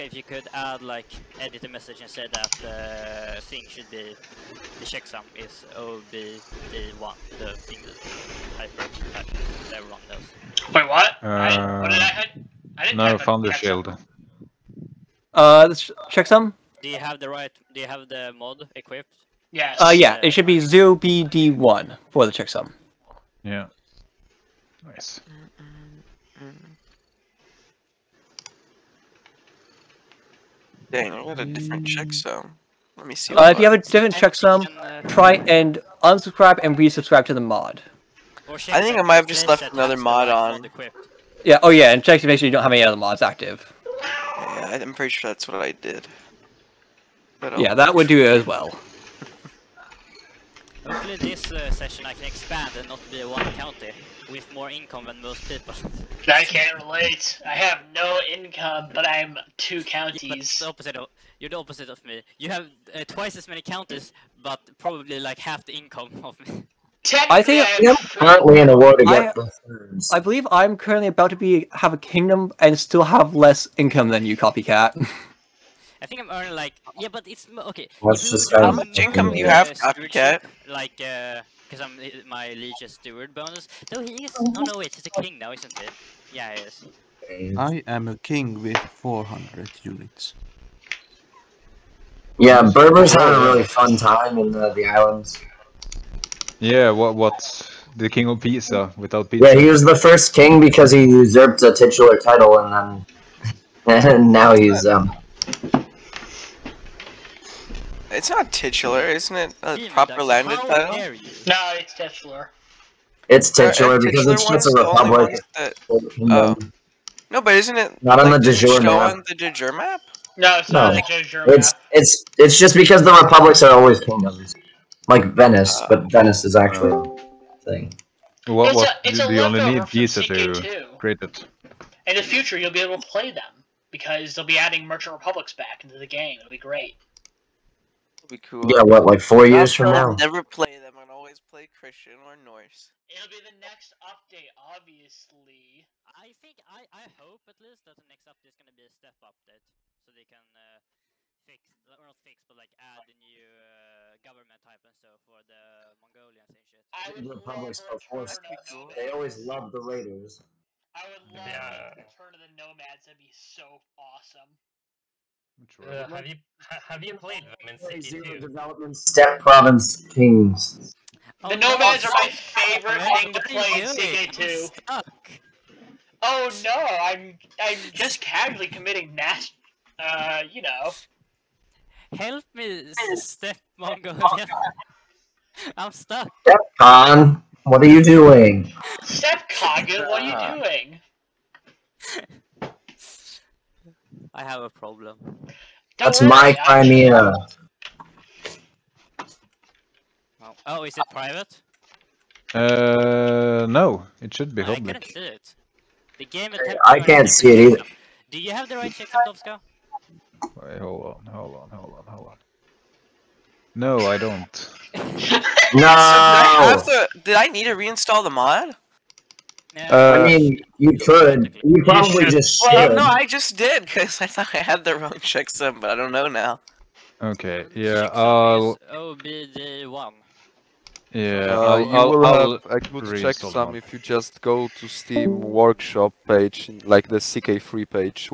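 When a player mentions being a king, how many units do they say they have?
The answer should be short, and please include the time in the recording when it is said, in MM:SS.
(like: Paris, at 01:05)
400, at 01:28.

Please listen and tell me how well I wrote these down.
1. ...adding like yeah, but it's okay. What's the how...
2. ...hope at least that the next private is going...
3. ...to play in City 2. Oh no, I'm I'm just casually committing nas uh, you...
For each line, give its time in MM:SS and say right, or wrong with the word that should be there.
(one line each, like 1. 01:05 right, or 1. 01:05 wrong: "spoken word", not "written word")
1. 01:16 wrong: "earning", not "adding"
2. 02:27 wrong: "update", not "private"
3. 02:53 right.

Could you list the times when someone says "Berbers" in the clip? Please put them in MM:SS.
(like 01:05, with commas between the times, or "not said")
01:32.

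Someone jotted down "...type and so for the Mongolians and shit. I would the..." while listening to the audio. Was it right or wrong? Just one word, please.
right.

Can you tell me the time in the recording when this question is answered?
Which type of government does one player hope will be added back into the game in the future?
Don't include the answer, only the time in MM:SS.
02:14.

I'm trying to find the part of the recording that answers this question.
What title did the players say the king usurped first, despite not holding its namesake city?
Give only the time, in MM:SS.
01:38.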